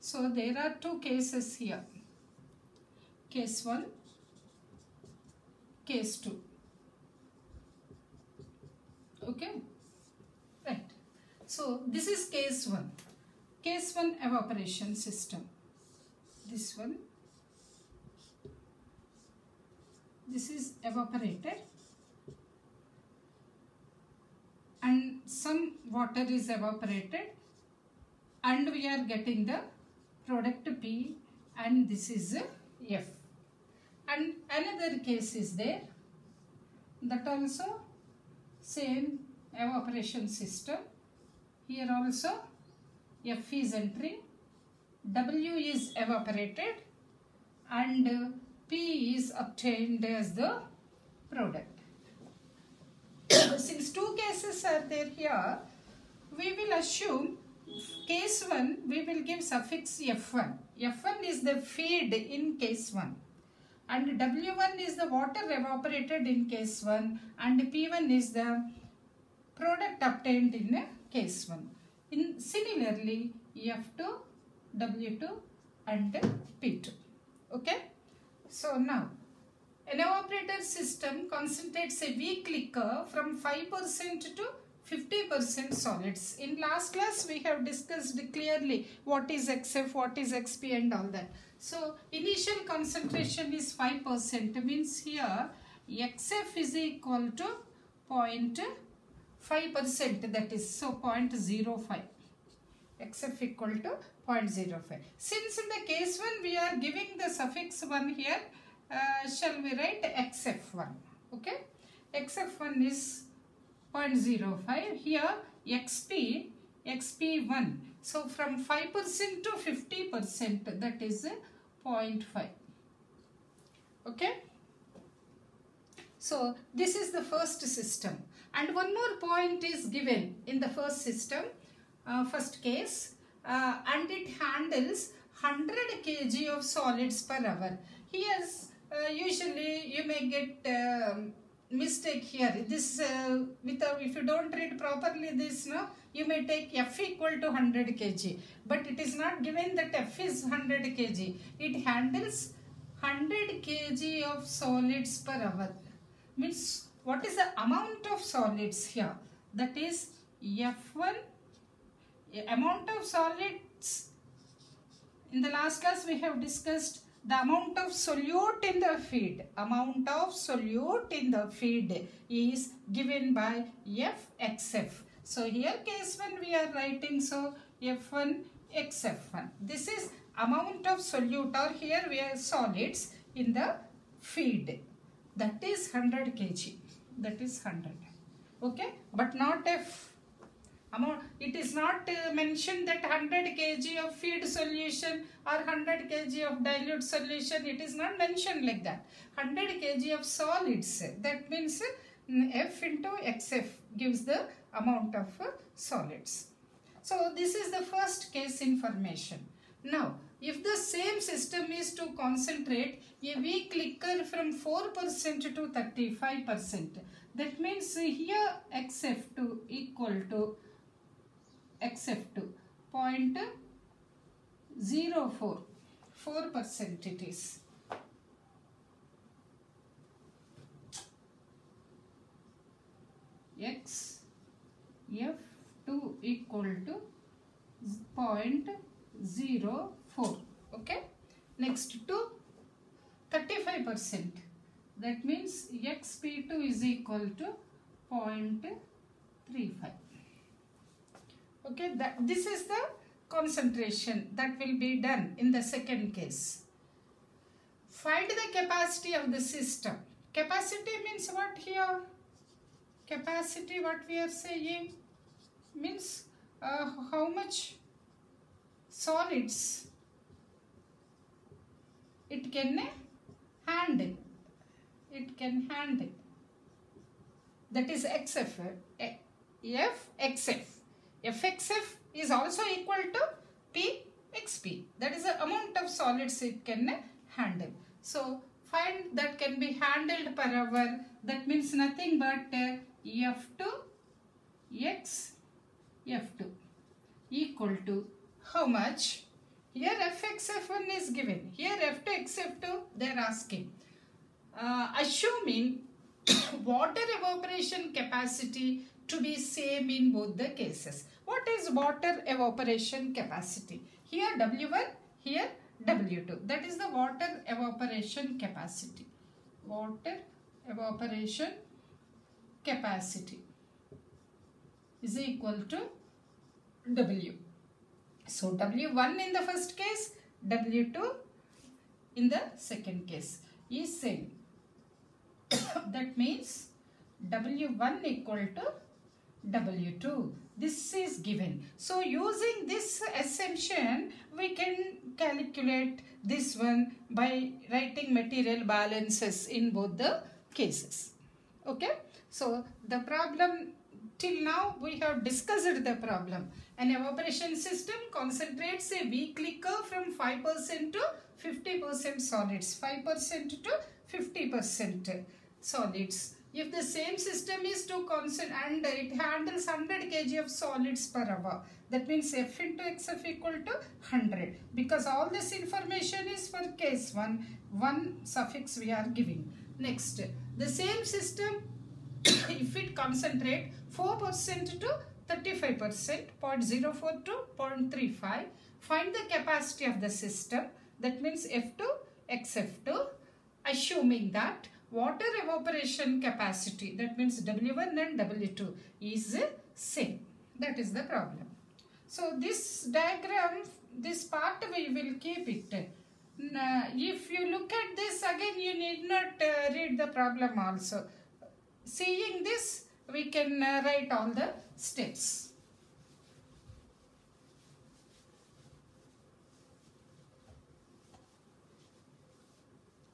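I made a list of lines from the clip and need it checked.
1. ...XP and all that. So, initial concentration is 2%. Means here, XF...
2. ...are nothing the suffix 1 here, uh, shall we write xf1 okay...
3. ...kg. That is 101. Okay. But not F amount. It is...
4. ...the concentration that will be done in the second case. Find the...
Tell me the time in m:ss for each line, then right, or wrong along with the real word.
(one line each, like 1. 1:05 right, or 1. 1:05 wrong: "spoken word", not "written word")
1. 1:30 wrong: "5", not "2"
2. 1:46 wrong: "giving", not "nothing"
3. 3:06 wrong: "100", not "101"
4. 4:12 right.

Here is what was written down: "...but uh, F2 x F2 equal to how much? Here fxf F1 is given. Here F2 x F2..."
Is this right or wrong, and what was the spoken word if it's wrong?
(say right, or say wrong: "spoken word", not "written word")
right.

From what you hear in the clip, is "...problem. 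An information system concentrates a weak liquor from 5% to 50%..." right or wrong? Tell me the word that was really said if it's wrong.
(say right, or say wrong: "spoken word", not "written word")
wrong: "evaporation", not "information".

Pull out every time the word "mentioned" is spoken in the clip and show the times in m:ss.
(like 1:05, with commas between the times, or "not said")
3:12, 3:18.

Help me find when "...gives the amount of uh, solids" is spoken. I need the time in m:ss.
3:23.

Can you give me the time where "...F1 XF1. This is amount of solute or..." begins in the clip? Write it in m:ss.
2:57.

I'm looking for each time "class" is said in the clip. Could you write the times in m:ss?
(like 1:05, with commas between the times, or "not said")
1:26, 2:45.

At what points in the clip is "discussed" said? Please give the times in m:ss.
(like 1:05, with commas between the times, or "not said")
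1:27, 2:46, 5:55.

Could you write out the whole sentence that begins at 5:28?
So W1 in the first case, W2 in the second case is same.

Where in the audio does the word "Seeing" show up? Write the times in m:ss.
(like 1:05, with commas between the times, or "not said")
6:51.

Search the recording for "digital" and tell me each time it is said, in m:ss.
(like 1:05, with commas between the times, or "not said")
not said.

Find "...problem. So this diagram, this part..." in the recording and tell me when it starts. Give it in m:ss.
6:41.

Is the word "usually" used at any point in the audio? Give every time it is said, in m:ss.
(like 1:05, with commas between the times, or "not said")
2:19.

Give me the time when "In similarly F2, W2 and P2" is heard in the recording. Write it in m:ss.
1:12.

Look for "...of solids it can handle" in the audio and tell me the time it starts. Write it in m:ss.
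4:45.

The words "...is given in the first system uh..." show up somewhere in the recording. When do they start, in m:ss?
2:09.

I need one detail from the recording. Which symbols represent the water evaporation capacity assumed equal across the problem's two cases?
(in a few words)
W1 and W2.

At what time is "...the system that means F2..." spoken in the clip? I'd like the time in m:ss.
6:30.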